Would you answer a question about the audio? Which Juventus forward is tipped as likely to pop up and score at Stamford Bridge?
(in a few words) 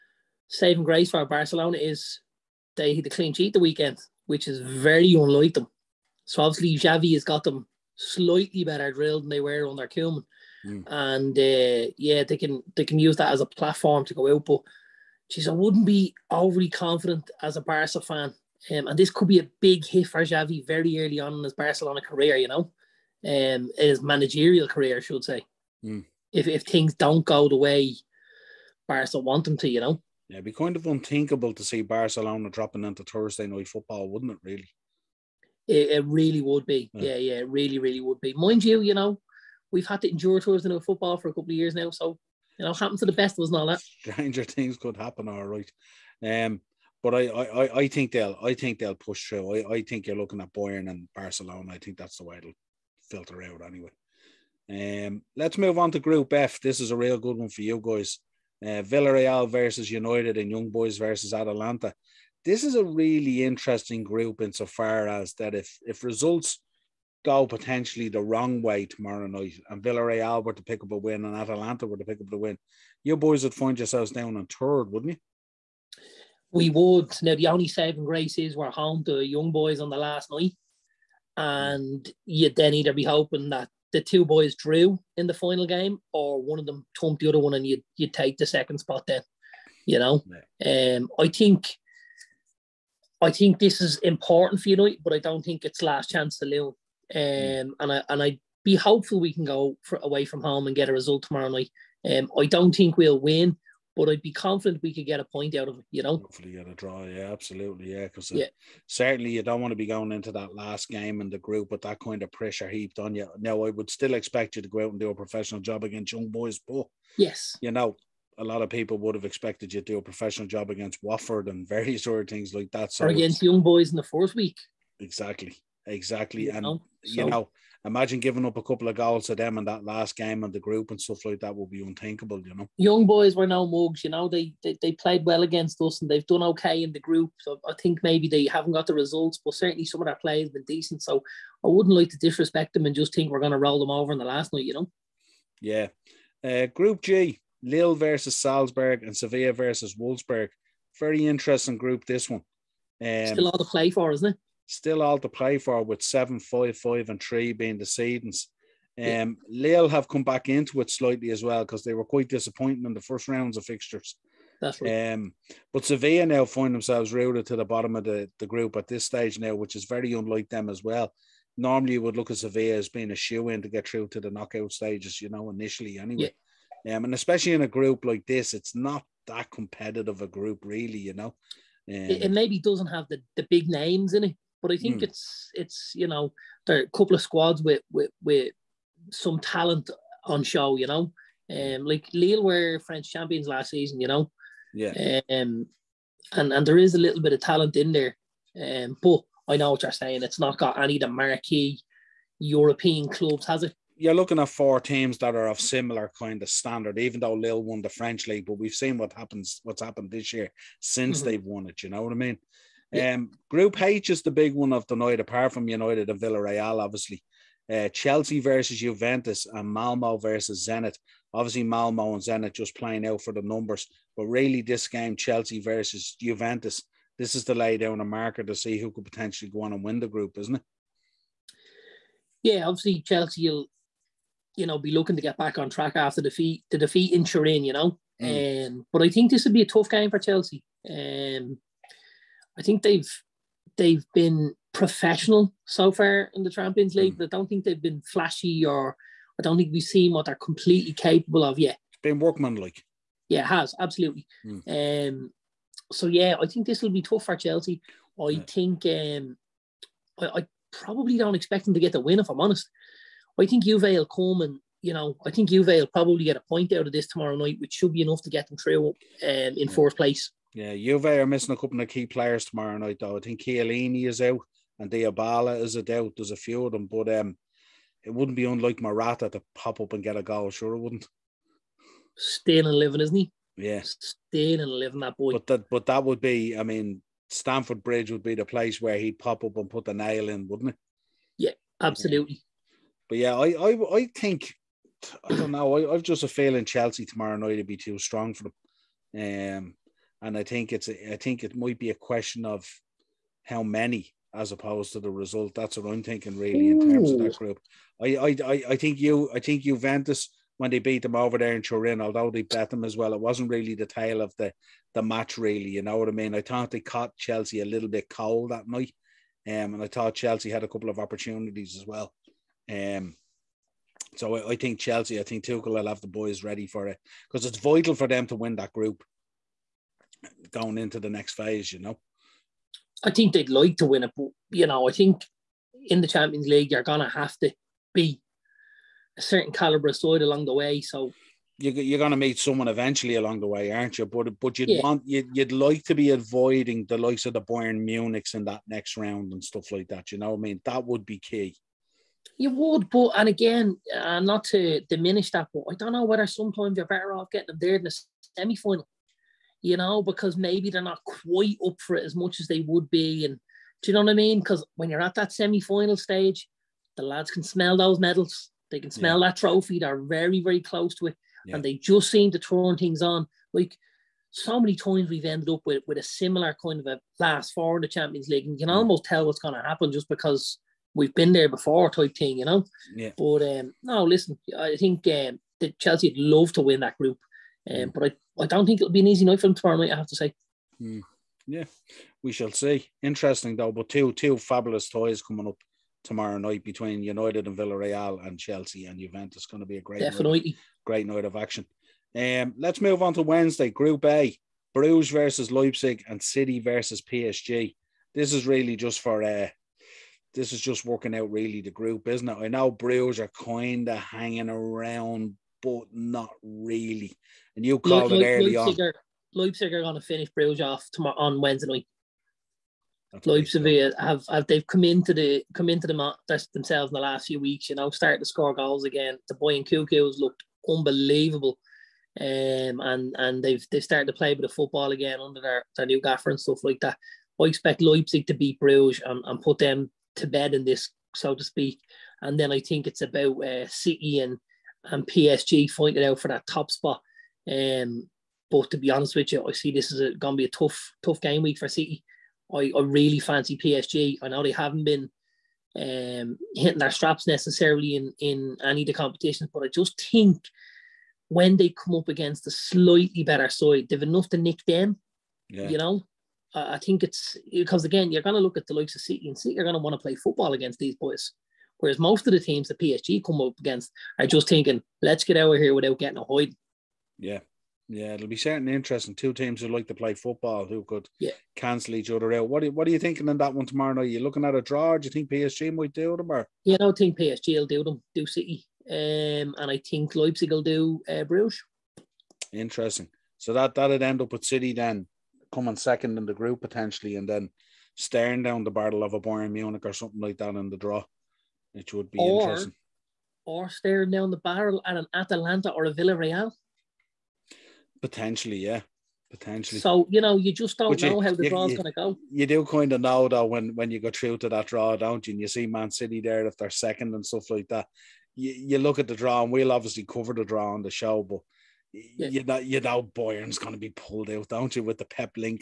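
Morata.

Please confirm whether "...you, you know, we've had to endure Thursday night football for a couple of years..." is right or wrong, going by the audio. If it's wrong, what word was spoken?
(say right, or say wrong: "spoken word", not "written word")
right.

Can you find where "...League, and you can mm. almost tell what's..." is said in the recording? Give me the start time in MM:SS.
06:18.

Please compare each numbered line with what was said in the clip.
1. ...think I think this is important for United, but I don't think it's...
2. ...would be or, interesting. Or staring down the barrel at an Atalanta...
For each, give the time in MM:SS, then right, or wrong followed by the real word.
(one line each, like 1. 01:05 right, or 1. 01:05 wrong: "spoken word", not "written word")
1. 01:31 right
2. 08:21 right.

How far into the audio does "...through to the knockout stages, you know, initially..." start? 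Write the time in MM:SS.
02:53.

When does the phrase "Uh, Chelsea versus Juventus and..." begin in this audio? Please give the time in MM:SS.
03:37.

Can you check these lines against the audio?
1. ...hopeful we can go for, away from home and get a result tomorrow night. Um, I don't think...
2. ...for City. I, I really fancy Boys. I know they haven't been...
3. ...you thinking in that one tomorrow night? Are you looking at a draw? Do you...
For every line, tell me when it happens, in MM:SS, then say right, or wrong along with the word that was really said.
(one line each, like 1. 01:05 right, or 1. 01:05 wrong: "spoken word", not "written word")
1. 01:38 right
2. 07:31 wrong: "PSG", not "Boys"
3. 08:02 right.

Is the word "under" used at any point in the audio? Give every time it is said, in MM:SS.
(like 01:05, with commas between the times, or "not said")
00:09, 07:15.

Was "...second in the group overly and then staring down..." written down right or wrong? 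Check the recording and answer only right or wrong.
wrong.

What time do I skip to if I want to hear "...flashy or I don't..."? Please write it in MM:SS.
04:08.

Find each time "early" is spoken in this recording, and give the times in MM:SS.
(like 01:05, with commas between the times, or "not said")
00:20, 06:58.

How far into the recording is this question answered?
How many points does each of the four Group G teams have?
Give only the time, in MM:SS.
02:36.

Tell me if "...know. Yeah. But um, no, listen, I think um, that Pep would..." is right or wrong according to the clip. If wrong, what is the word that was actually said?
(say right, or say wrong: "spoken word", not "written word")
wrong: "Chelsea", not "Pep".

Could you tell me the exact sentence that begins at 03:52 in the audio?
Yeah, obviously, Chelsea will, you know, be looking to get back on track after defeat the defeat in Turin, you know.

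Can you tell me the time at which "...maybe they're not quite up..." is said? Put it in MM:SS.
06:00.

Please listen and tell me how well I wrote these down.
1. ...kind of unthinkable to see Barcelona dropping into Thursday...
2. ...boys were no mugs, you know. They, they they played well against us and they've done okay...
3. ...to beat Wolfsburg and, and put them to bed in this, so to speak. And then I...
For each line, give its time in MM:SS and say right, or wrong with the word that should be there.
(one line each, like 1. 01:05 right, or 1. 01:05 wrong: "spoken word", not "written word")
1. 00:30 right
2. 02:13 right
3. 07:18 wrong: "Bruges", not "Wolfsburg".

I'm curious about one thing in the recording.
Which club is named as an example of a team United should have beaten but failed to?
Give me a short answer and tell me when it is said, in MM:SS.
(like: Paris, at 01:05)
Watford, at 02:01.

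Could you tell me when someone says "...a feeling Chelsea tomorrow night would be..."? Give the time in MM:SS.
04:56.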